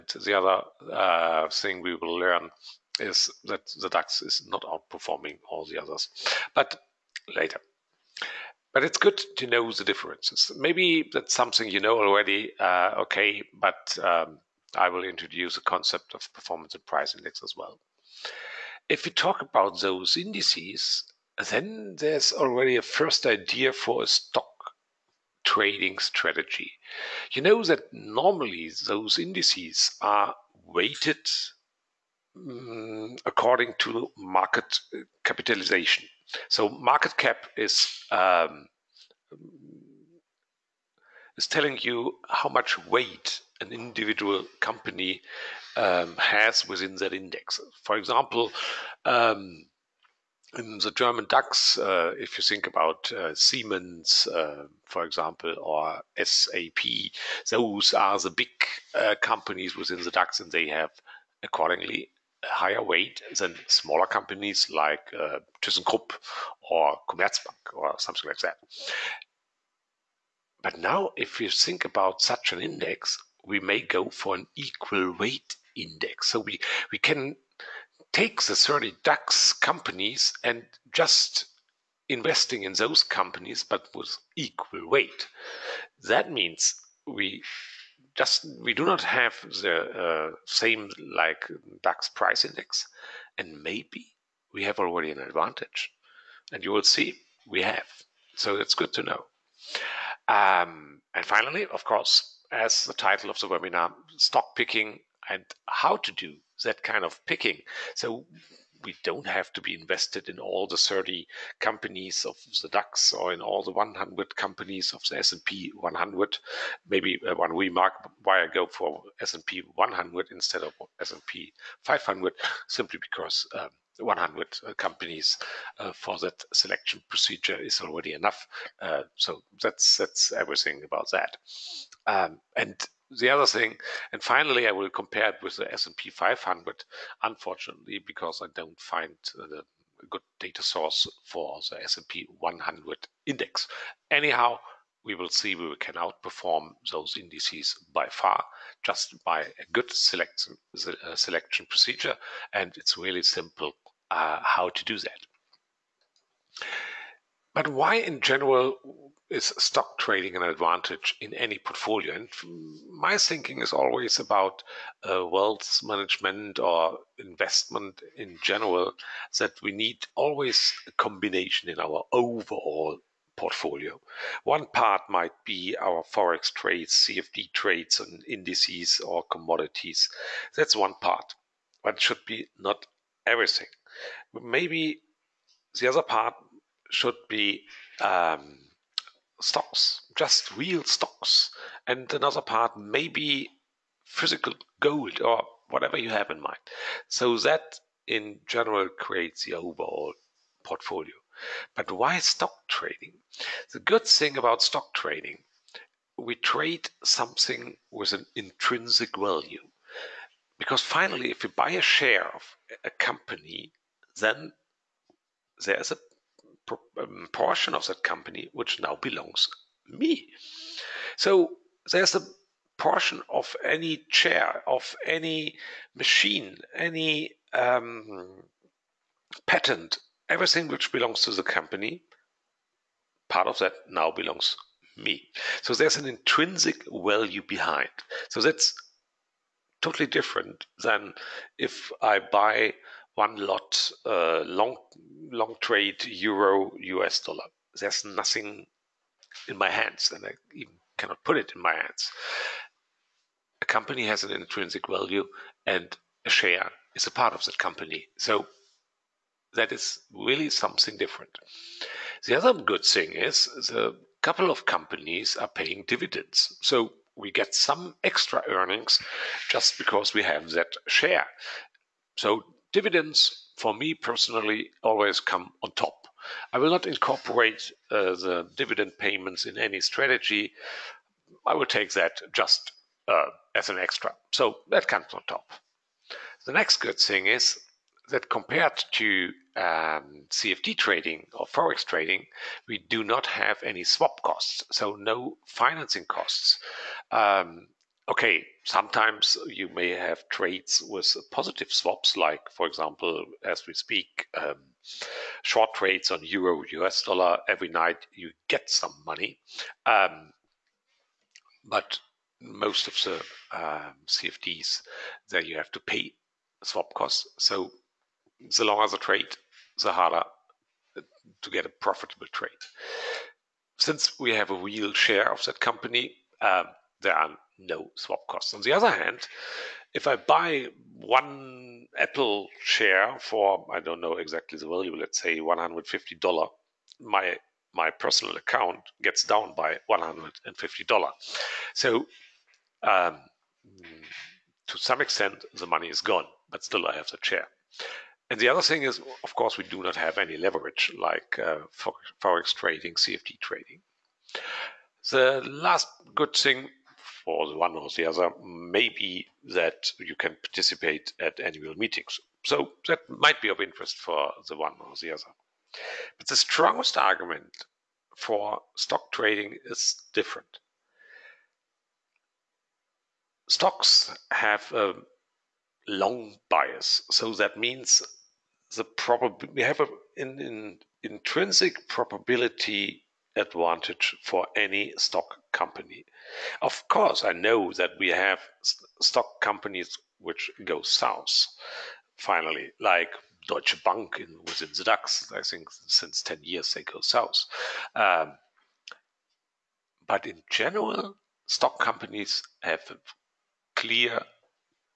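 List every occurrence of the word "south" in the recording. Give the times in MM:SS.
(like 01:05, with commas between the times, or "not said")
06:30, 06:37.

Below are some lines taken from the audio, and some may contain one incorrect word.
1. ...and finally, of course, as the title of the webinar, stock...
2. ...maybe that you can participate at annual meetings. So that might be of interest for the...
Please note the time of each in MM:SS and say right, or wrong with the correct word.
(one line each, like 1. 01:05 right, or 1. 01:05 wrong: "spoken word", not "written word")
1. 01:41 right
2. 05:58 right.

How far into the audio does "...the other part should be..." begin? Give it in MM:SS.
03:05.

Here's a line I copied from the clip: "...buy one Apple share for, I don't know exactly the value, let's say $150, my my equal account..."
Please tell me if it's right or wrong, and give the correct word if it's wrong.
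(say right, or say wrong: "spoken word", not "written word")
wrong: "personal", not "equal".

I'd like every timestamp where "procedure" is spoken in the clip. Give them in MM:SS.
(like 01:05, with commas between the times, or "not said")
02:07, 02:31.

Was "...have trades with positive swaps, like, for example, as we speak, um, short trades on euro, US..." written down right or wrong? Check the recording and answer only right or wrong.
right.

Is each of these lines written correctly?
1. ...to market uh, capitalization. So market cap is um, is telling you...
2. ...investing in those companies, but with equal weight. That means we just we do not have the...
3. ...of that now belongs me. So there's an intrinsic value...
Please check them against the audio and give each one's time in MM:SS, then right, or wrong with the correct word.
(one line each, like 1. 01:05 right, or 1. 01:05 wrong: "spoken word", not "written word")
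1. 00:33 right
2. 01:22 right
3. 03:53 right.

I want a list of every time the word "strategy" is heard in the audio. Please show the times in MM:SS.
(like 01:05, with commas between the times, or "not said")
00:25, 04:39.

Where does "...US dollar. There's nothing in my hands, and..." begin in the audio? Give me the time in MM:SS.
04:06.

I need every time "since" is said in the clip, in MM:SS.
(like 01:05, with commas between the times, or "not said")
05:23, 06:35.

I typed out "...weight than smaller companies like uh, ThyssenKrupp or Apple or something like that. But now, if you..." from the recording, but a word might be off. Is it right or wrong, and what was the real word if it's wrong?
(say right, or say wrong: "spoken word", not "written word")
wrong: "Commerzbank", not "Apple".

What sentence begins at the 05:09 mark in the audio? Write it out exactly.
Um, but most of the um, CFDs, there you have to pay swap costs.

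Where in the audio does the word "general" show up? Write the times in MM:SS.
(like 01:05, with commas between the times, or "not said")
02:38, 02:48, 03:18, 06:40.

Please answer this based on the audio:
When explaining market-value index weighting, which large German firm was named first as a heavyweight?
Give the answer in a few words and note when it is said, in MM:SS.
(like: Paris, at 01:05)
Siemens, at 00:53.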